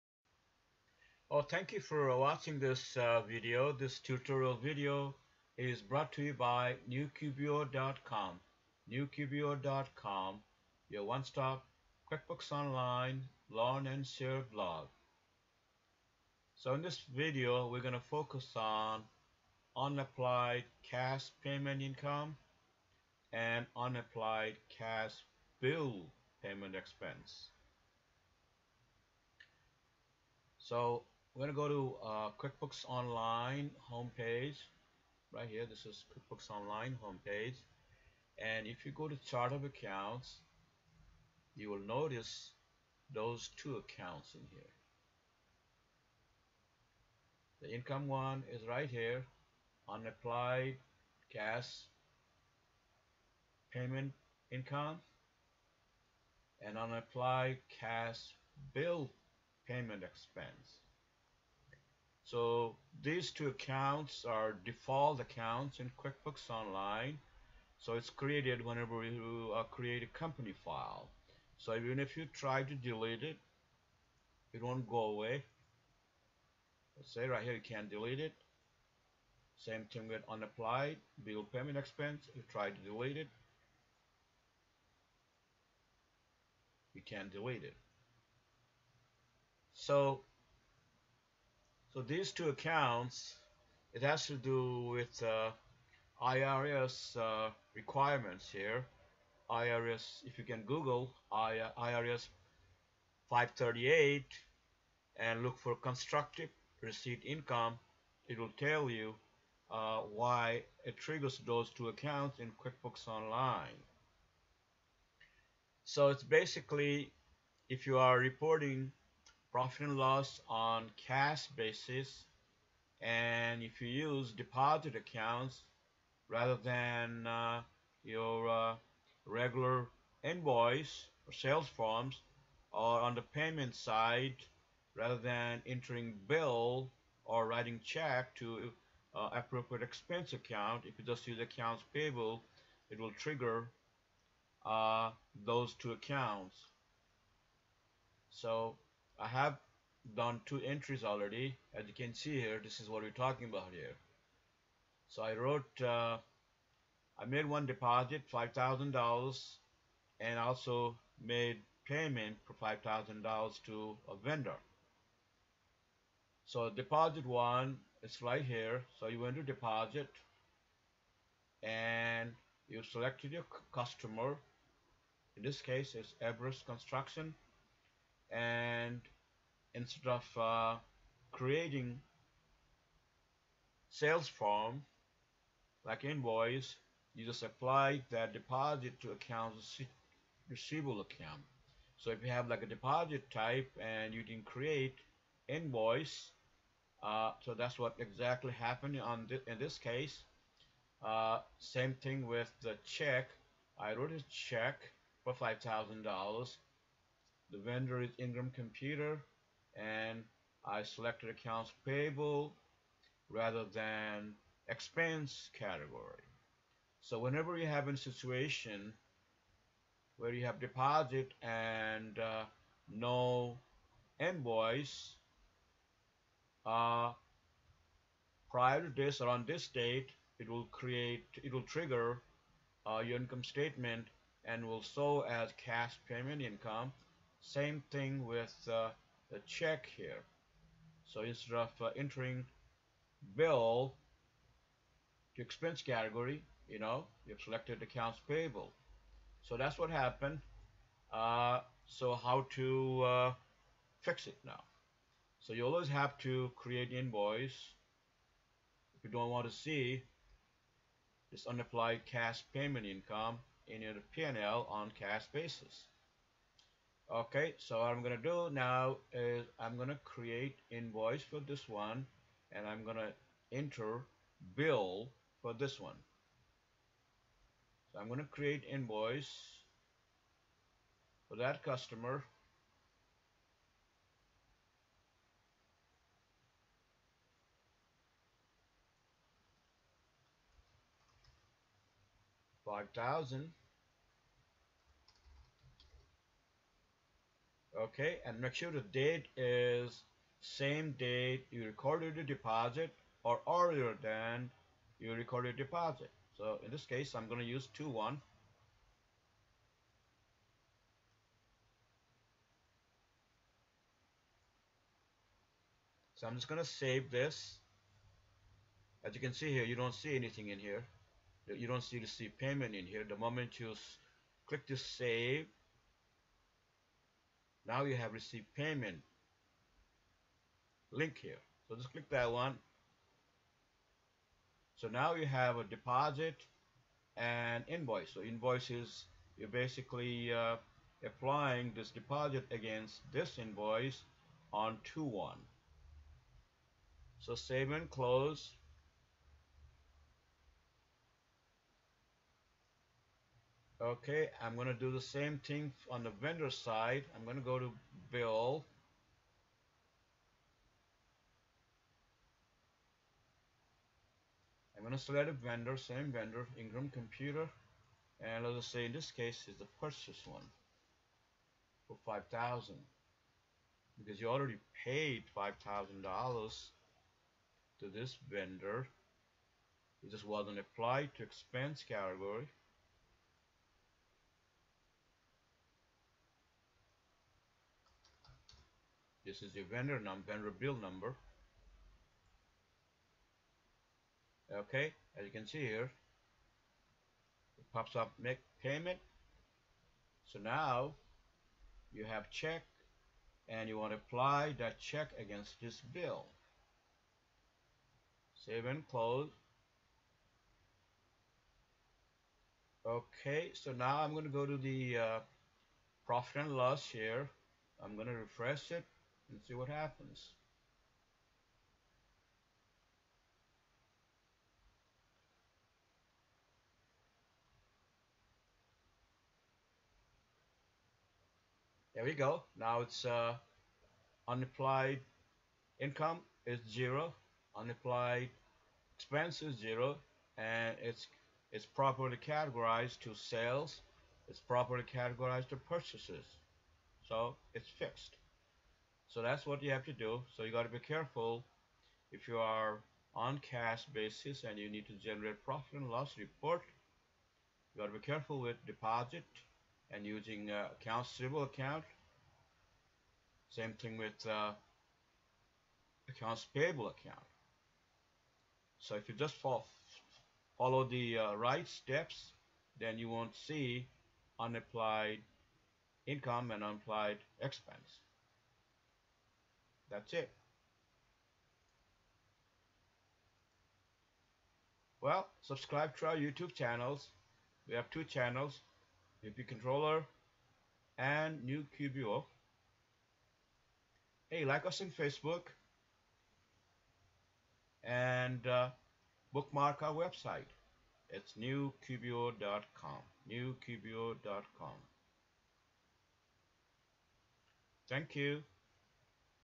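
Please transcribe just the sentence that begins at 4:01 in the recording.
So instead of uh, entering bill to expense category, you know, you've selected accounts payable.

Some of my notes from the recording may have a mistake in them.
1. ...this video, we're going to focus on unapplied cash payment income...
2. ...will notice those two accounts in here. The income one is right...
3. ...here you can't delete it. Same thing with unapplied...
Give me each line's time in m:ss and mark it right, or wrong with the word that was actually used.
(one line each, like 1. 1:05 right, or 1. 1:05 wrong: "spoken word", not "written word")
1. 0:16 right
2. 0:41 right
3. 1:17 right.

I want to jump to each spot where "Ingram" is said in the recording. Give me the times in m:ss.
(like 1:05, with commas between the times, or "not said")
3:28, 6:06.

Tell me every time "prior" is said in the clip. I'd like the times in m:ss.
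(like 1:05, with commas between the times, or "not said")
3:48.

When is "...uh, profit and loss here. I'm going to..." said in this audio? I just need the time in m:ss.
6:54.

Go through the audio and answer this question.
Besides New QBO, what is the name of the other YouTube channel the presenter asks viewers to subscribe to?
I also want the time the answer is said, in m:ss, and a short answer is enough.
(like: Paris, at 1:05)
VP Controller, at 8:09.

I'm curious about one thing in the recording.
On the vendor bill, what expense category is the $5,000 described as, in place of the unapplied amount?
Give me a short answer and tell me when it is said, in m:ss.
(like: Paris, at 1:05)
Purchase, at 6:09.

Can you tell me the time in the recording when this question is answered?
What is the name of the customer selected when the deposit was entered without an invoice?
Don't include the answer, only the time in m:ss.
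2:56.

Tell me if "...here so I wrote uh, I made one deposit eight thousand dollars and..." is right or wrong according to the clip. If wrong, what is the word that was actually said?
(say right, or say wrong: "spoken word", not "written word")
wrong: "five", not "eight".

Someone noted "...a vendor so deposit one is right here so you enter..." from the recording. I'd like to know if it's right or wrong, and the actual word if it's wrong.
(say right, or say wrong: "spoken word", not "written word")
right.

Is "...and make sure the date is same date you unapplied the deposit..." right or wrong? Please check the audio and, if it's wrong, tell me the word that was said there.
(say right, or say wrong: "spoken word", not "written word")
wrong: "recorded", not "unapplied".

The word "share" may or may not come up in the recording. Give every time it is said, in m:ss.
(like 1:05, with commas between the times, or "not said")
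0:14.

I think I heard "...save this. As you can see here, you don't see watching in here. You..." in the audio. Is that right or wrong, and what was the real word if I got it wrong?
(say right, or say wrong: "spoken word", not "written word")
wrong: "anything", not "watching".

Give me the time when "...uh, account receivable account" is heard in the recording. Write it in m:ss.
7:40.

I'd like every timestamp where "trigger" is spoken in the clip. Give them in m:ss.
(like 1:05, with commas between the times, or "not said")
1:50, 2:23, 3:51.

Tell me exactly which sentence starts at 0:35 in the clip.
Right here, this is QuickBooks Online homepage.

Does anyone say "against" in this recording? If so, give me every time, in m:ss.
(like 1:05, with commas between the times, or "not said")
5:42, 6:45.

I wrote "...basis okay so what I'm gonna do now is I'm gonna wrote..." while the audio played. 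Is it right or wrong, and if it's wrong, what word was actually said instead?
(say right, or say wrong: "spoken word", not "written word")
wrong: "create", not "wrote".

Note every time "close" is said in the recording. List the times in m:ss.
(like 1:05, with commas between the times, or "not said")
5:47, 6:48.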